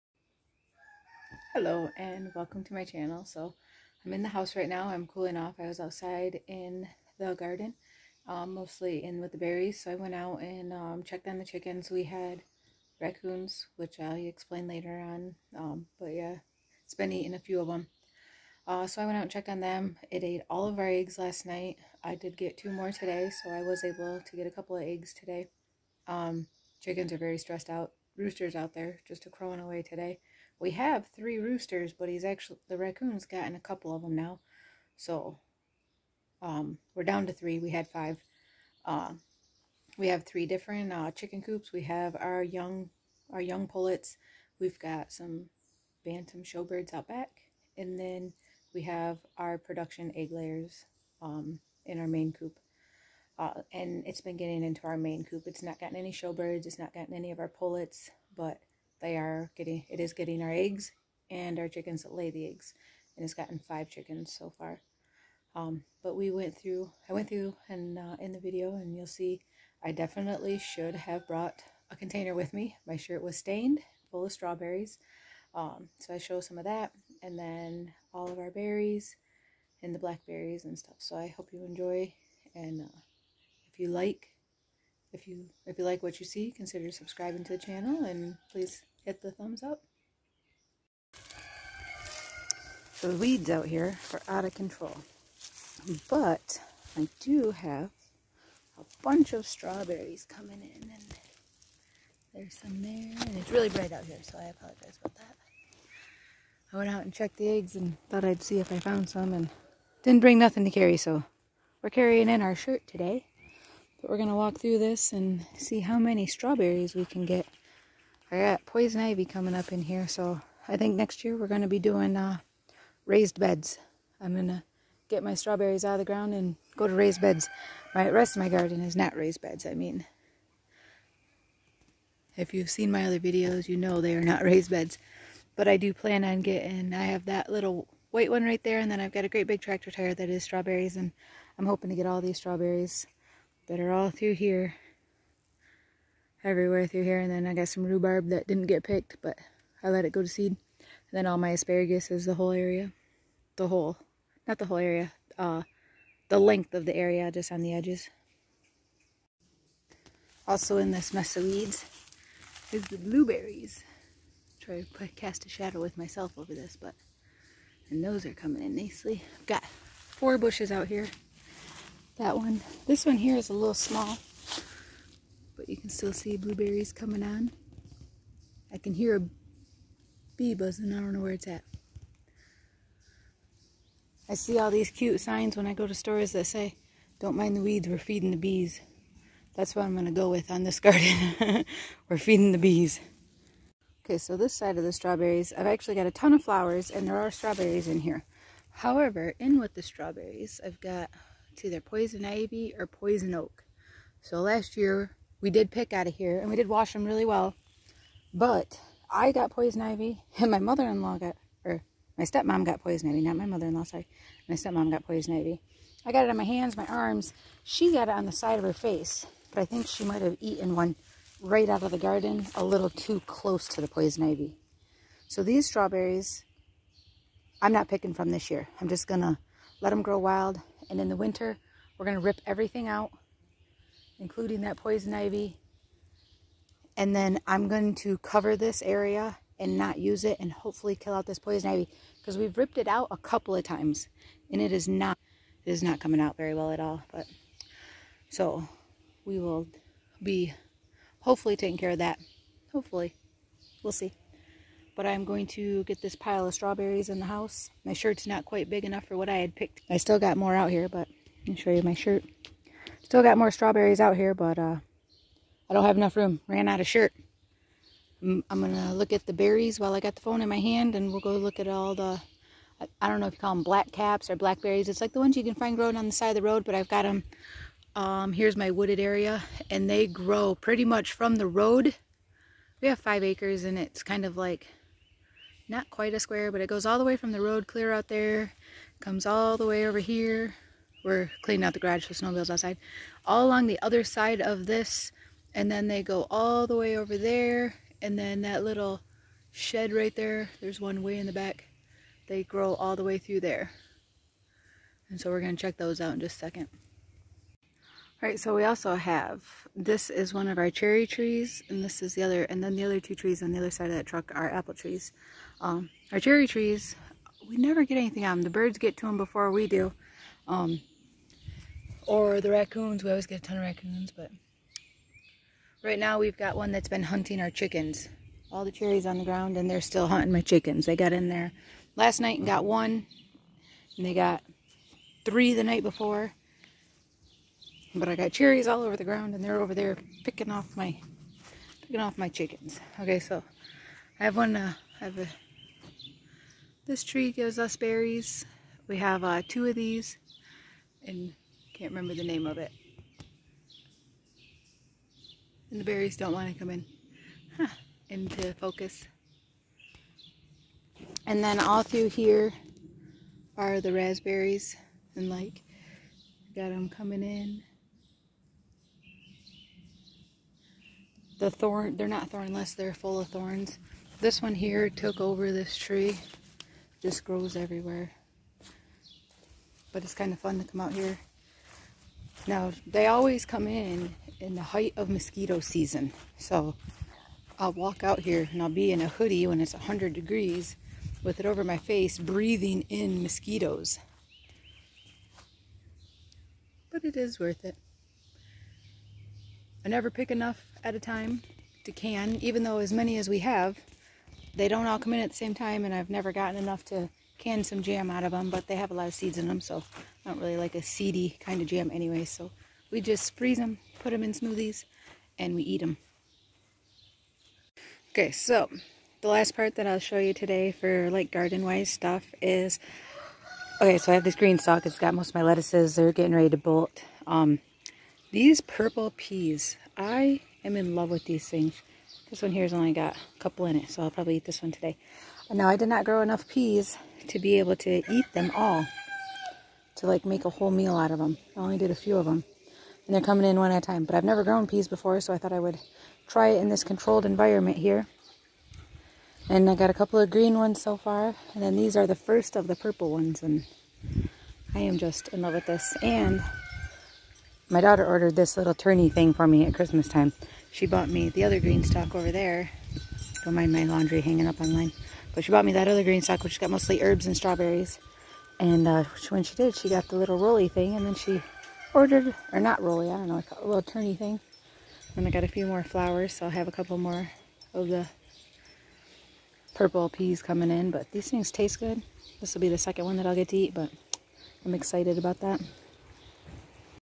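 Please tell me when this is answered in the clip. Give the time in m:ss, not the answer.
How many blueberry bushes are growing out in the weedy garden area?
2:49.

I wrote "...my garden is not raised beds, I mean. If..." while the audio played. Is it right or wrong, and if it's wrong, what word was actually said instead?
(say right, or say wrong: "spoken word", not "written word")
right.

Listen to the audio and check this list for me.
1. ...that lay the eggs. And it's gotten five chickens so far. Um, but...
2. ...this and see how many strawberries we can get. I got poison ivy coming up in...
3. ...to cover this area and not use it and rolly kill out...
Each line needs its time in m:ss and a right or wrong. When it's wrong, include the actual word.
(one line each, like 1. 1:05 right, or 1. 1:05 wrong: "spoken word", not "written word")
1. 1:02 right
2. 1:54 right
3. 3:57 wrong: "hopefully", not "rolly".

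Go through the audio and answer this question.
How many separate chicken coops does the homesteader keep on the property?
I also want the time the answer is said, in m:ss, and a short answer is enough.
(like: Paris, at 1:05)
3, at 0:40.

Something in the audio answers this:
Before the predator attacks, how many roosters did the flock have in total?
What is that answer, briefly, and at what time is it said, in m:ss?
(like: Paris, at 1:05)
5, at 0:37.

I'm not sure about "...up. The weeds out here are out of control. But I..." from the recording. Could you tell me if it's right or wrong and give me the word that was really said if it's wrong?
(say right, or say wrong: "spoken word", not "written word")
right.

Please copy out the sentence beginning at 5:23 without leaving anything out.
We always get a ton of raccoons, but right now we've got one that's been hunting our chickens.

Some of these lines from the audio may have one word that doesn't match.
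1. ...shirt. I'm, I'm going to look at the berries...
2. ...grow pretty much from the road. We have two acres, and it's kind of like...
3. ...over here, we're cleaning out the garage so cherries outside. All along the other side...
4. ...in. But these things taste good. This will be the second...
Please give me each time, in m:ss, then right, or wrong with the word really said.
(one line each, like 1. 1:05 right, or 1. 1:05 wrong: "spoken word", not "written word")
1. 4:26 right
2. 4:40 wrong: "five", not "two"
3. 4:49 wrong: "snowmobiles", not "cherries"
4. 8:00 right.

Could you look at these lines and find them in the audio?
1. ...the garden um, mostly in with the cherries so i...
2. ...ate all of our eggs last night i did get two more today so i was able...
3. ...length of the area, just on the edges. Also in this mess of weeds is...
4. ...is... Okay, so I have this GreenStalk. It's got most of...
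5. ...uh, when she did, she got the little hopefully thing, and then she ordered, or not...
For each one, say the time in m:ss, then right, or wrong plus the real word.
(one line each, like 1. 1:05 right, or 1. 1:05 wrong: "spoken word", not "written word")
1. 0:07 wrong: "berries", not "cherries"
2. 0:20 right
3. 2:36 right
4. 7:02 right
5. 7:48 wrong: "rolly", not "hopefully".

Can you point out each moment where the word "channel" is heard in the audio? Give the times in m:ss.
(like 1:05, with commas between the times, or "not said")
0:02, 1:27.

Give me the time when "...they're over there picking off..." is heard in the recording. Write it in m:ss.
5:39.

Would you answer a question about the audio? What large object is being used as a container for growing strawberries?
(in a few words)
tractor tire.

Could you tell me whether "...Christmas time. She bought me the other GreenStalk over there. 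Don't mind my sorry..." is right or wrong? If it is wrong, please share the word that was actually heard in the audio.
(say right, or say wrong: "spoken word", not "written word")
wrong: "laundry", not "sorry".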